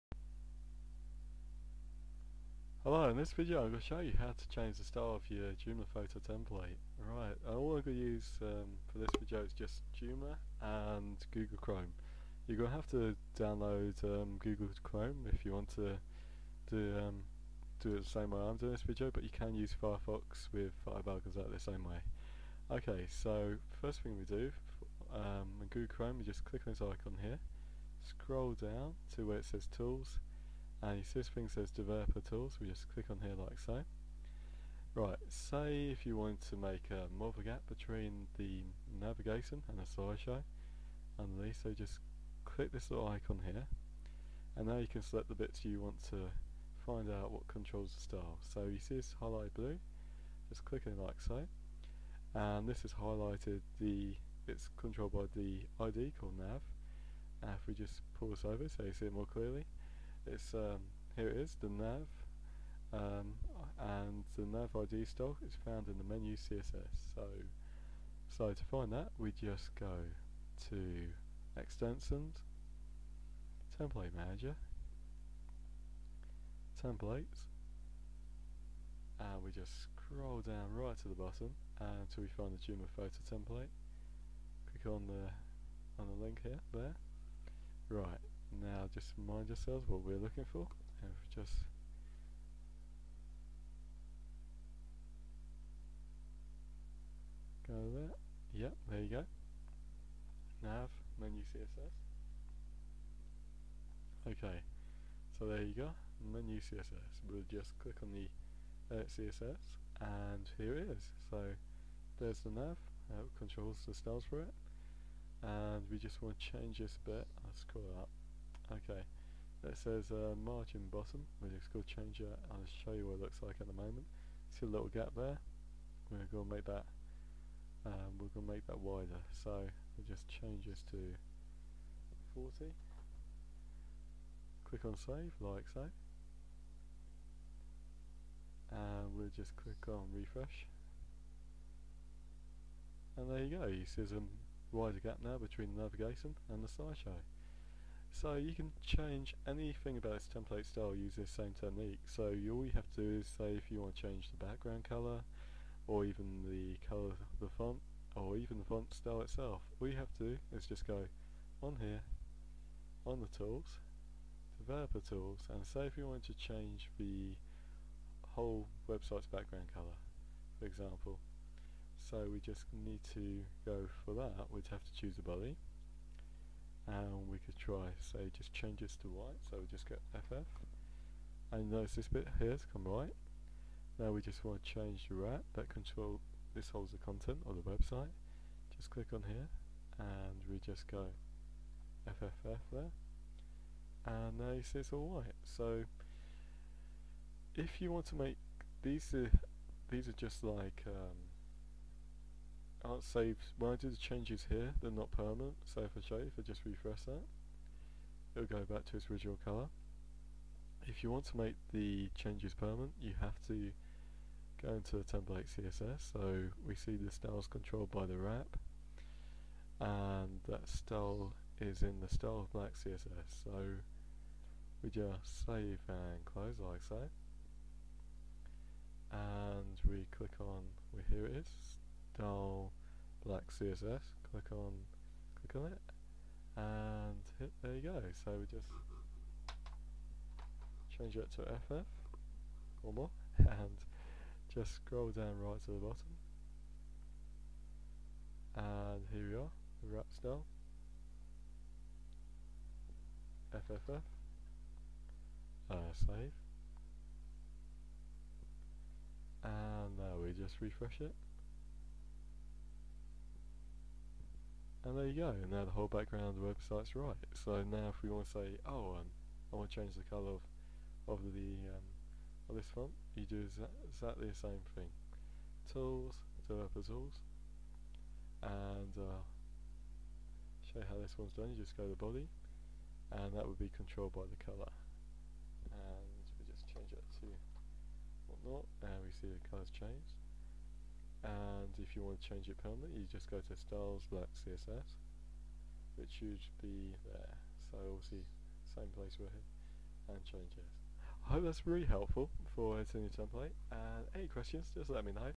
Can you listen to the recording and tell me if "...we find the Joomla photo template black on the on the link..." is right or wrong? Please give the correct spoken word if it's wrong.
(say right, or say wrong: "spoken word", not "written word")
wrong: "click", not "black".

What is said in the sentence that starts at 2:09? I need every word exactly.
So we'll just change this to 40.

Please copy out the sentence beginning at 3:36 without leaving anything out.
So we see the styles controlled by the wrap, and that style is in the style of black CSS.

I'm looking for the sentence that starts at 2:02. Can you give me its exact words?
I'll show you what it looks like at the moment.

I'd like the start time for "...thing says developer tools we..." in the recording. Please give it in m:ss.
0:31.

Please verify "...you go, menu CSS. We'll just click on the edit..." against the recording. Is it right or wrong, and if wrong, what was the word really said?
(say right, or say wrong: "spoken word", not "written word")
right.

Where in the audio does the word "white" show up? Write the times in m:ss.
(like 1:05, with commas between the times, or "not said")
2:59, 3:15.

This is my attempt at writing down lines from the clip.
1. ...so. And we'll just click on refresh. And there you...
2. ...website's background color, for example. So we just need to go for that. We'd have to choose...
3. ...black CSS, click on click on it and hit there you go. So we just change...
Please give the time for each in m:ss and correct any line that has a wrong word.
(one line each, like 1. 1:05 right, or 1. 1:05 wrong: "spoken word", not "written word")
1. 2:15 right
2. 2:48 right
3. 3:53 right.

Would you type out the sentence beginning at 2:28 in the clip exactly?
So you can change anything about this template style using this same technique.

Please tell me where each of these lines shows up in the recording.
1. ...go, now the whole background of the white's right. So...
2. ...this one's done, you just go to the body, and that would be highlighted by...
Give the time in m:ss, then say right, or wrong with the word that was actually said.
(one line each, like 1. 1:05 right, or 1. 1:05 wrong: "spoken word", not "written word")
1. 4:25 wrong: "website", not "white"
2. 4:40 wrong: "controlled", not "highlighted".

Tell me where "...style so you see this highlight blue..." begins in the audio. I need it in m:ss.
0:48.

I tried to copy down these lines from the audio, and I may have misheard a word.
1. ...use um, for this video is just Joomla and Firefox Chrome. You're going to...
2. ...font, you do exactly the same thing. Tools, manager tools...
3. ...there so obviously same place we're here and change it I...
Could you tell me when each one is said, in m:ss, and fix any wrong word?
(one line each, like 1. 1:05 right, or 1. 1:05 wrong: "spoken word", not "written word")
1. 0:07 wrong: "Google", not "Firefox"
2. 4:32 wrong: "developer", not "manager"
3. 4:57 right.